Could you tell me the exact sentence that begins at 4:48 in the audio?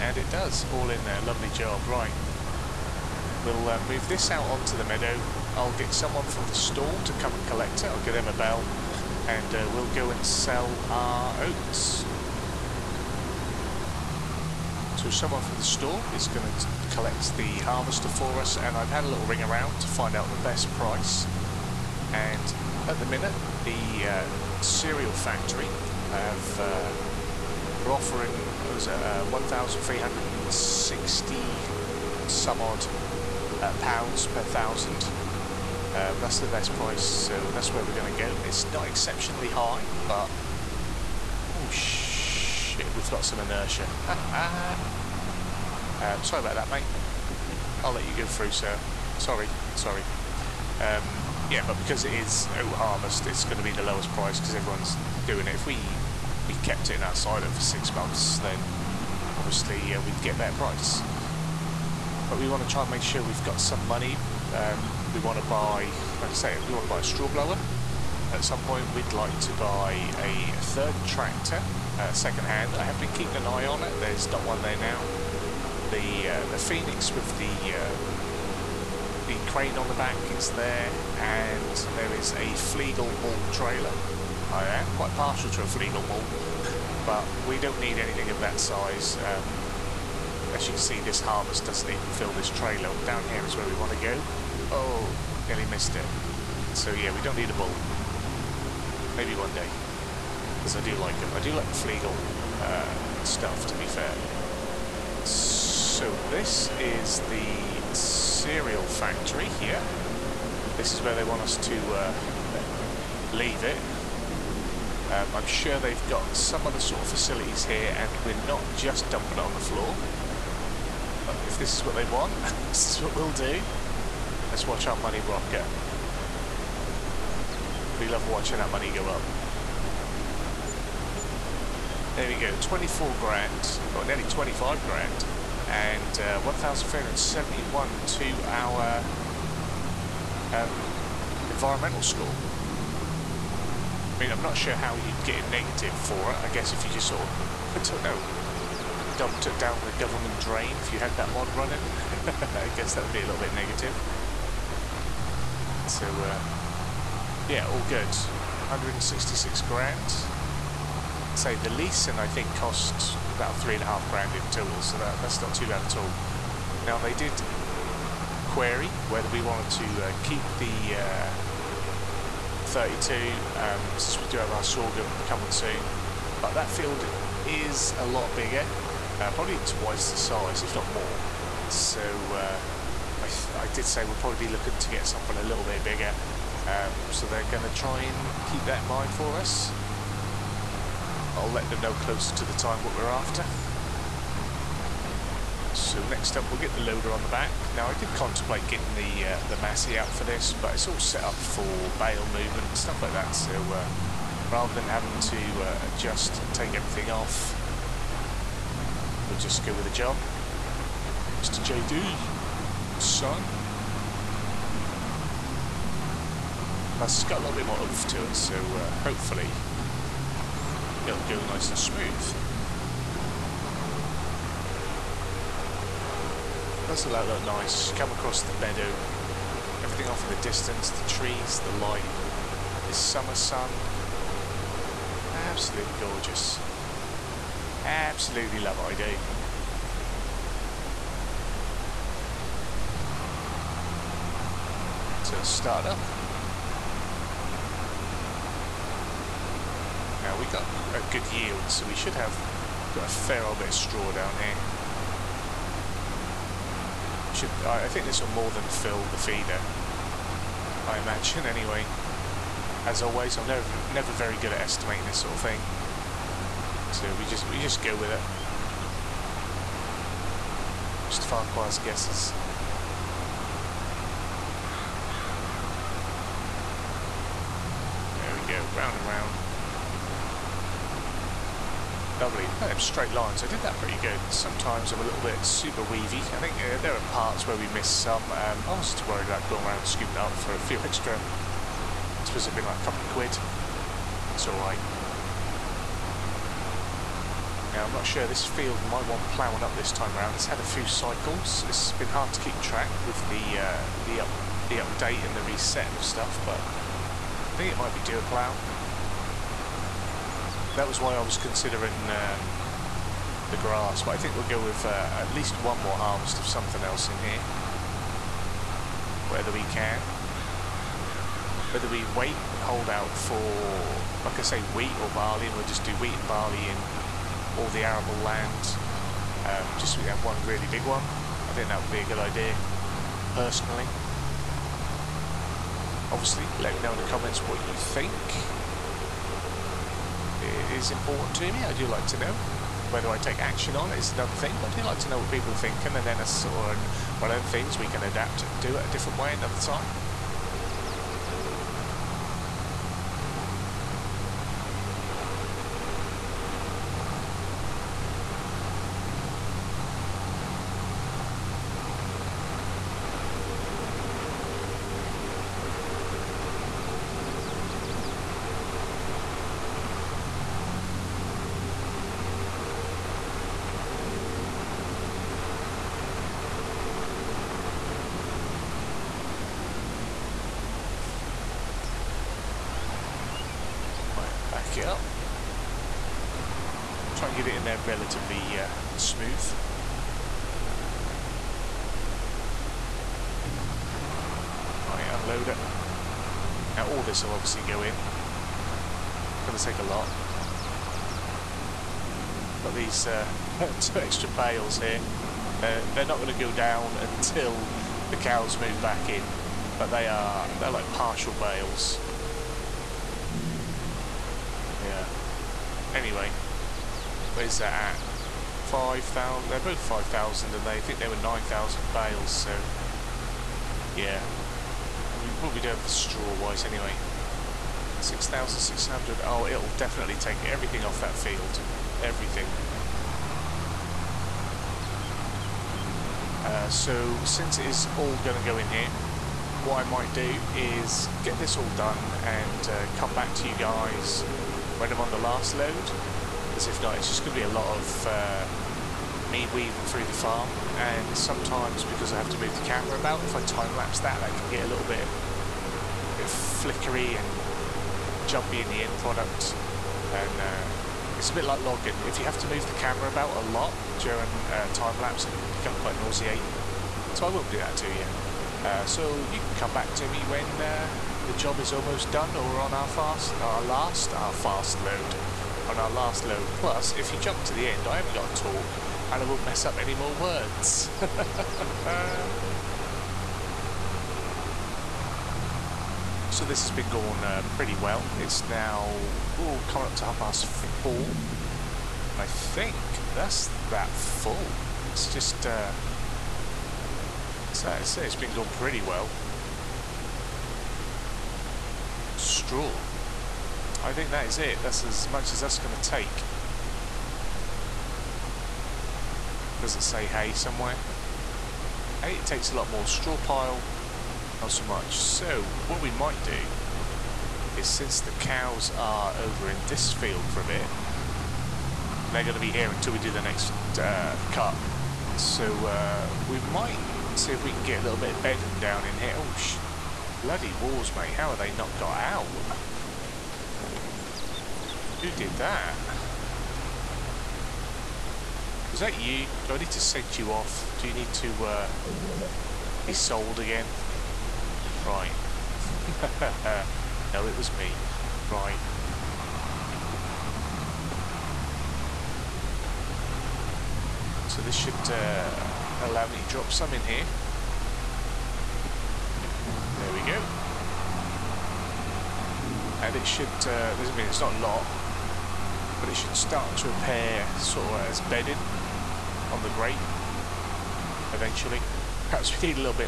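Um, I was too worried about going around scooping up for a few extra.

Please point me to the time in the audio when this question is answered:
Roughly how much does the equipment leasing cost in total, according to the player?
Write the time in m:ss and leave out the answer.
2:43.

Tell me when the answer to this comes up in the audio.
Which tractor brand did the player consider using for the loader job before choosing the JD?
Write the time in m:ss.
3:19.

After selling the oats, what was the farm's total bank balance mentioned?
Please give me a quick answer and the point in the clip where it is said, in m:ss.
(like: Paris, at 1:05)
166 grand, at 2:38.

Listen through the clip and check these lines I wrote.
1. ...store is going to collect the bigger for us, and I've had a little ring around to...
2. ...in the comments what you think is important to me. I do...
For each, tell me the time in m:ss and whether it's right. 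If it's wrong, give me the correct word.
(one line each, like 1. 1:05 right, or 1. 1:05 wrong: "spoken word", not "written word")
1. 0:15 wrong: "harvester", not "bigger"
2. 5:36 right.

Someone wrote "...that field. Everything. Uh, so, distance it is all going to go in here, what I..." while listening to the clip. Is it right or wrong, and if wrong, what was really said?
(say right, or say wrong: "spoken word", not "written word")
wrong: "since", not "distance".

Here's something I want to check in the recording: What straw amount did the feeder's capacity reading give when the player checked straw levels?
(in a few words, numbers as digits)
6,600.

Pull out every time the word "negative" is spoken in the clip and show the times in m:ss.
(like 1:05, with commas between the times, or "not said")
2:25, 2:33.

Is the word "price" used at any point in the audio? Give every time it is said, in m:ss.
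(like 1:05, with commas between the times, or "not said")
0:20, 0:36, 0:54, 1:00.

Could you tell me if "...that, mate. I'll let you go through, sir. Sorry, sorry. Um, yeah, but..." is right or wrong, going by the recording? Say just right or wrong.
right.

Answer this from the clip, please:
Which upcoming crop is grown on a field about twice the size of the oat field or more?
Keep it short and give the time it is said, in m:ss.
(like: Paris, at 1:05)
sorghum, at 2:54.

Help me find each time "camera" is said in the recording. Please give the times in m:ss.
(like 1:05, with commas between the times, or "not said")
7:32, 7:42.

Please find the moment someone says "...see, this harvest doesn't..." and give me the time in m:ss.
1:30.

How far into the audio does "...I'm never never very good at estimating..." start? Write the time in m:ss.
4:23.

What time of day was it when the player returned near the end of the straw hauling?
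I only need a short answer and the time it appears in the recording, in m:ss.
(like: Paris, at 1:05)
half past four, at 8:10.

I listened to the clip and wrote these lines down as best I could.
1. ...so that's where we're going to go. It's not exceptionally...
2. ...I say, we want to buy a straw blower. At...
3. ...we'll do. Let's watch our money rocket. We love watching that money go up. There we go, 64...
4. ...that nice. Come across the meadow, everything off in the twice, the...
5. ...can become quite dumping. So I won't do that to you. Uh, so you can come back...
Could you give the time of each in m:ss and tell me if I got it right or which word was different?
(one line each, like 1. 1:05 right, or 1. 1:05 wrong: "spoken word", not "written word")
1. 0:37 right
2. 1:06 right
3. 2:03 wrong: "24", not "64"
4. 3:47 wrong: "distance", not "twice"
5. 7:45 wrong: "nauseating", not "dumping".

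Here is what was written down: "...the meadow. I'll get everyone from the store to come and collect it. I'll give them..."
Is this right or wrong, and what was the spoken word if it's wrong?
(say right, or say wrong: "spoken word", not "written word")
wrong: "someone", not "everyone".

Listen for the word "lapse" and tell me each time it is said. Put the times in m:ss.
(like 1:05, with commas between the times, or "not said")
7:33, 7:45.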